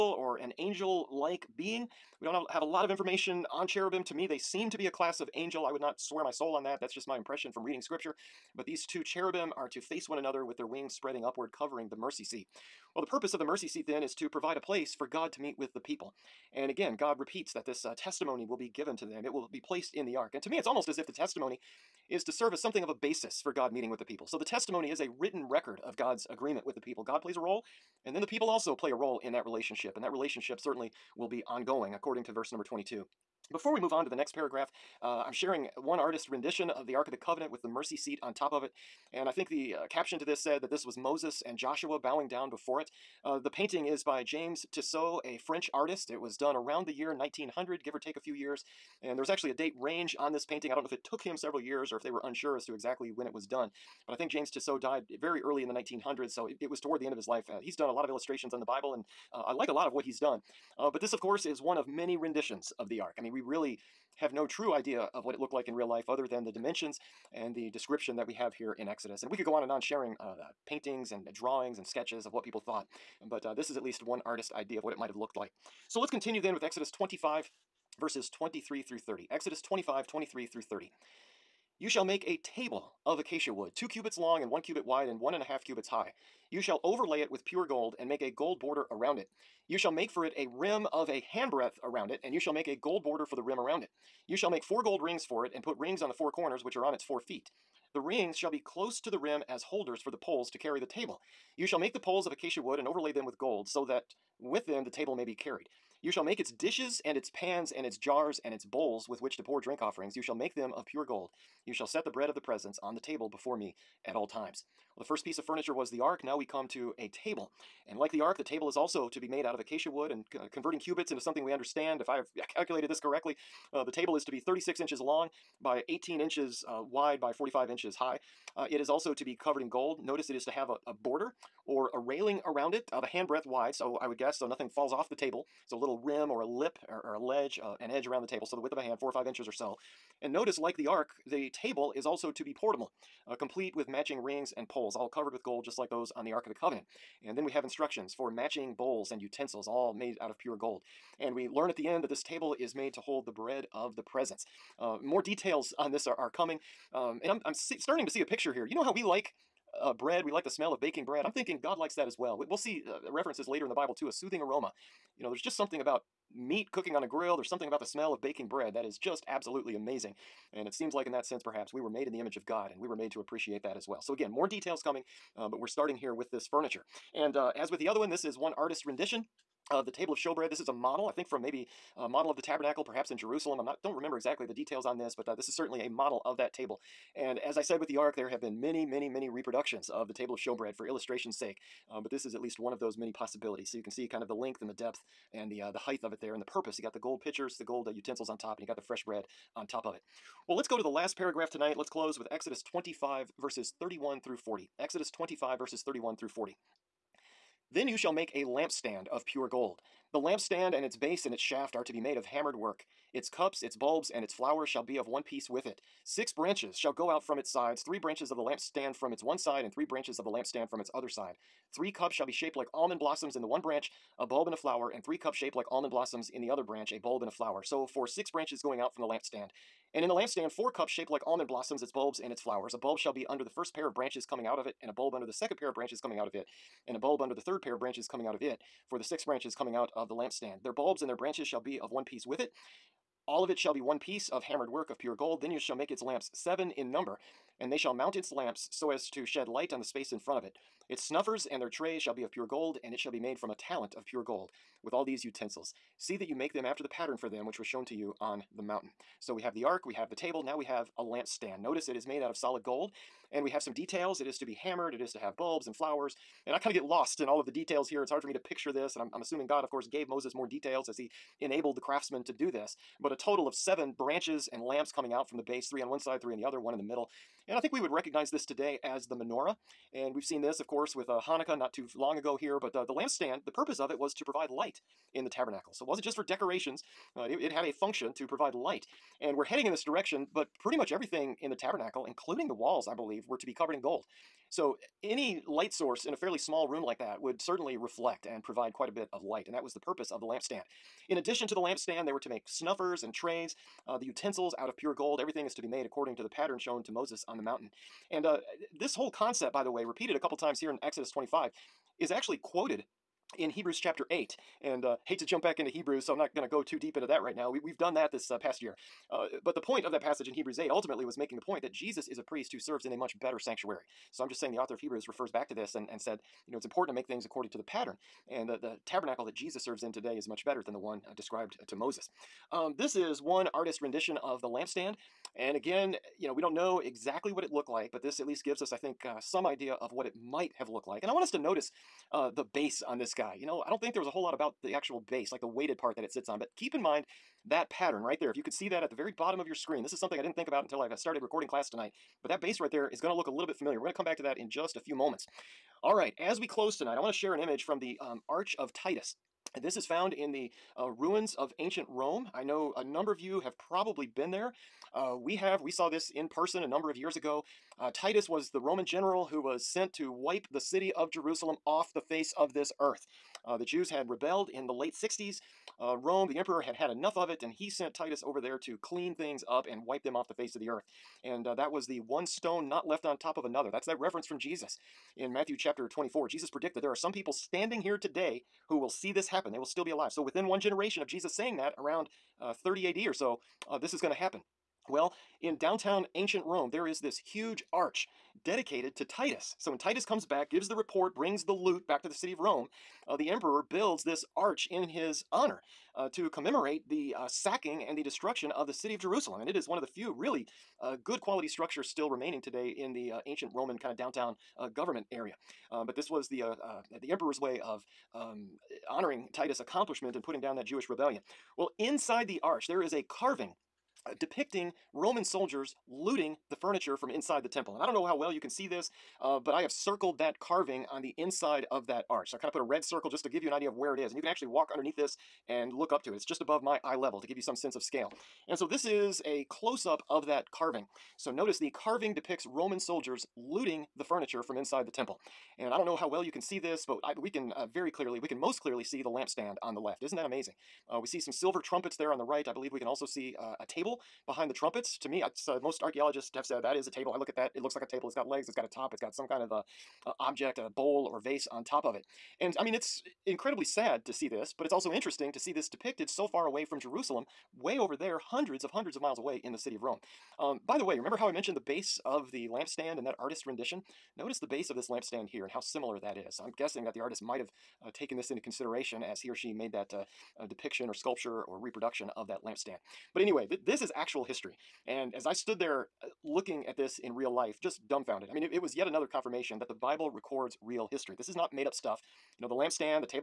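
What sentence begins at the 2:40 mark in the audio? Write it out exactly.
We like the smell of baking bread.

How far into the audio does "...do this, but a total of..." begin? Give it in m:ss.
4:32.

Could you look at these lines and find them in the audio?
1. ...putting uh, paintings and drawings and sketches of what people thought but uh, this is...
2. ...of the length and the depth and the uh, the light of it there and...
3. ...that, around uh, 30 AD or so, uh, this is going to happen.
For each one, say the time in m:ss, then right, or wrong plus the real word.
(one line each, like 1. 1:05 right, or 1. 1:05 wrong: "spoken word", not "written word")
1. 1:09 wrong: "sharing", not "putting"
2. 3:14 wrong: "height", not "light"
3. 6:31 right.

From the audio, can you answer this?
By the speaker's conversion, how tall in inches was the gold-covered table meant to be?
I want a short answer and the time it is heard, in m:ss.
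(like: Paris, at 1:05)
45 inches, at 2:07.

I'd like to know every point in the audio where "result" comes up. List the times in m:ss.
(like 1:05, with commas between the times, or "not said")
not said.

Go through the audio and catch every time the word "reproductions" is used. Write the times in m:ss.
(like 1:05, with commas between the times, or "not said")
3:09, 8:01.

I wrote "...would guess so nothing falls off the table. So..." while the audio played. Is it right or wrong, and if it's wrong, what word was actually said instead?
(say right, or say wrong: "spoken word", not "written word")
right.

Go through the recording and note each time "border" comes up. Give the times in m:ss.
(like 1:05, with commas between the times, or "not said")
1:28, 1:33, 2:10.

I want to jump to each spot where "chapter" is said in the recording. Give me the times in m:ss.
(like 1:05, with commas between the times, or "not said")
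5:13, 6:25.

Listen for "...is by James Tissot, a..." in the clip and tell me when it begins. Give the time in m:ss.
0:43.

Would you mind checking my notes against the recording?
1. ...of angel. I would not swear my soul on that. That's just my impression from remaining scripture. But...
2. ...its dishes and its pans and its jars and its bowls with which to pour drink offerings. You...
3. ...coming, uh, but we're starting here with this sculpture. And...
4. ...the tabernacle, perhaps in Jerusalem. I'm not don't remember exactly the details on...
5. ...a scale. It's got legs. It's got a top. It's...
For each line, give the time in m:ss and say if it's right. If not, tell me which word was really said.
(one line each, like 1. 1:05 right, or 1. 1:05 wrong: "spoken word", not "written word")
1. 0:05 wrong: "reading", not "remaining"
2. 1:46 right
3. 2:54 wrong: "furniture", not "sculpture"
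4. 3:02 right
5. 7:37 wrong: "table", not "scale".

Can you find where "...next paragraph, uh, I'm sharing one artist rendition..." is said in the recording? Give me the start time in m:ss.
0:34.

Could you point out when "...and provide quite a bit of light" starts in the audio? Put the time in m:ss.
4:58.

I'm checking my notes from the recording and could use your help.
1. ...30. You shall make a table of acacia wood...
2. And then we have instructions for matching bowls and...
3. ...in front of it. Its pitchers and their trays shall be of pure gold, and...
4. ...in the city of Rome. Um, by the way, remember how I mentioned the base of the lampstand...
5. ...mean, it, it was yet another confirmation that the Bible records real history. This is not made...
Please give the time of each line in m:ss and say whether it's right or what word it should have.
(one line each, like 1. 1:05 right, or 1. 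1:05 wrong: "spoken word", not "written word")
1. 1:20 right
2. 2:27 right
3. 4:10 wrong: "snuffers", not "pitchers"
4. 7:49 right
5. 8:08 right.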